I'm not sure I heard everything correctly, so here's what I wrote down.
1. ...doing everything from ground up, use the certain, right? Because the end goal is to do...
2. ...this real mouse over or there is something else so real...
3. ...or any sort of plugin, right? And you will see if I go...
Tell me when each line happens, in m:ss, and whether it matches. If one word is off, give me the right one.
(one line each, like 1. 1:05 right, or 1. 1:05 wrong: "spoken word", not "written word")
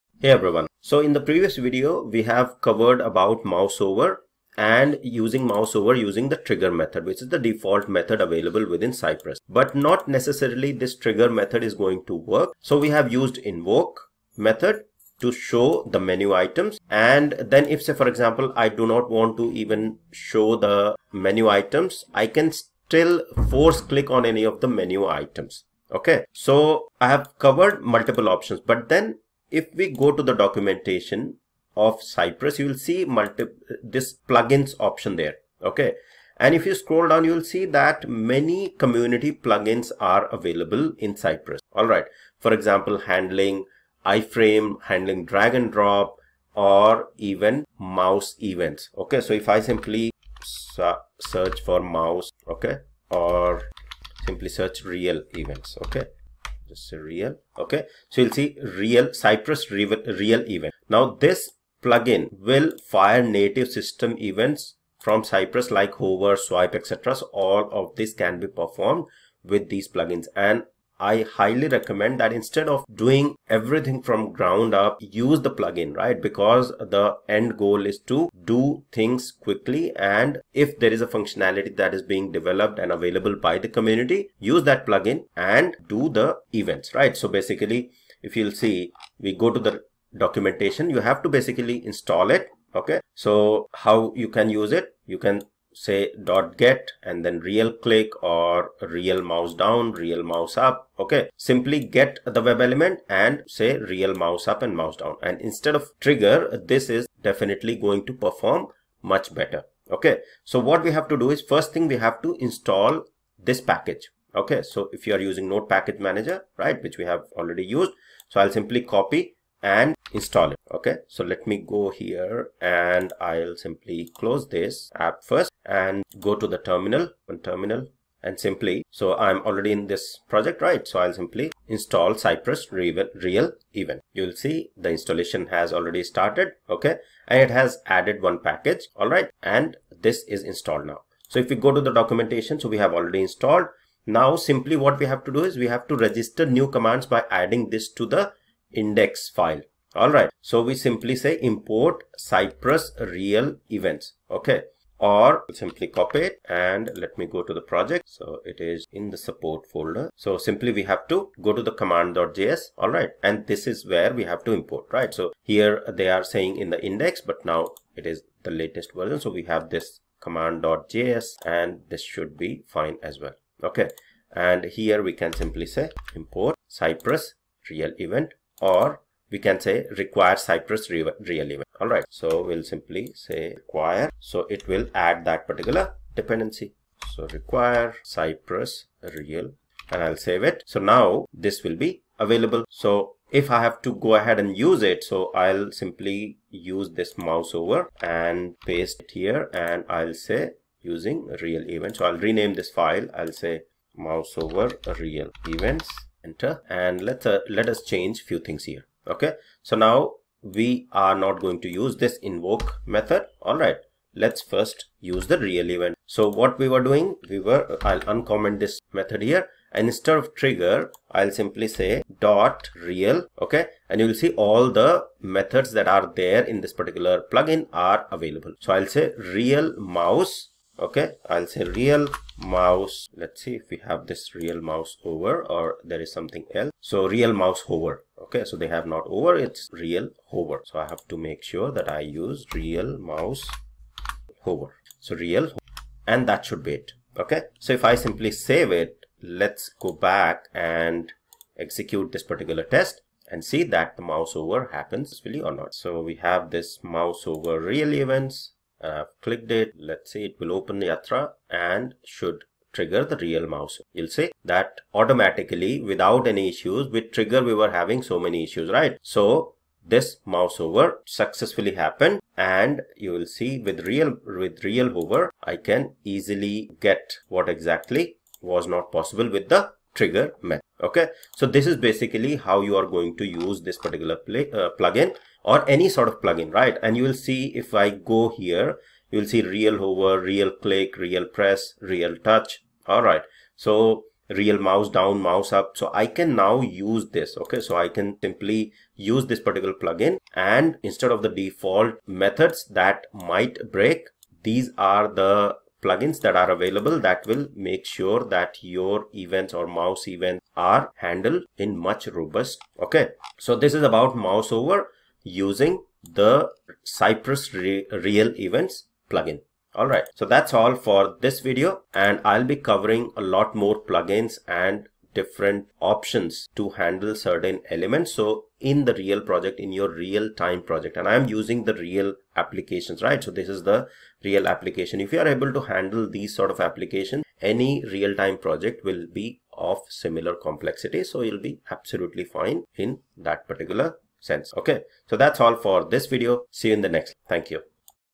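1. 1:12 wrong: "plugin", not "certain"
2. 3:54 right
3. 4:45 right.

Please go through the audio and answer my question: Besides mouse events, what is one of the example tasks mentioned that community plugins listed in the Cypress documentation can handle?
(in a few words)
iframe.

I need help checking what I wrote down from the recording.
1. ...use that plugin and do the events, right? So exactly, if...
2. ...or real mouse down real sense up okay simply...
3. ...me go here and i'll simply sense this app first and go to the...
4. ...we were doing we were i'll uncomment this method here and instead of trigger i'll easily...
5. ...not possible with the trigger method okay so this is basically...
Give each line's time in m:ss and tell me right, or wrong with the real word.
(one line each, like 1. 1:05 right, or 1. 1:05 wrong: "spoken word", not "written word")
1. 1:24 wrong: "basically", not "exactly"
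2. 1:38 wrong: "mouse", not "sense"
3. 2:01 wrong: "close", not "sense"
4. 3:36 wrong: "simply", not "easily"
5. 4:38 right.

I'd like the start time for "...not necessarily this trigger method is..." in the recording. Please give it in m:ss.
0:09.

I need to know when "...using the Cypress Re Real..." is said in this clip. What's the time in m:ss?
5:15.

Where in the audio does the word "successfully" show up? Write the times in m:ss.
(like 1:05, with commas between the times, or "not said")
4:31.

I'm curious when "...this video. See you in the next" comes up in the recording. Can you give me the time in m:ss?
5:45.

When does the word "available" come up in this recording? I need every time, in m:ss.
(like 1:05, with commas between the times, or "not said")
0:08, 0:40, 1:22, 3:12, 3:48, 5:06.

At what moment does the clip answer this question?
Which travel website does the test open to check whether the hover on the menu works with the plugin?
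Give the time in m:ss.
4:20.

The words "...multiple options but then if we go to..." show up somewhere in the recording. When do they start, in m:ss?
0:27.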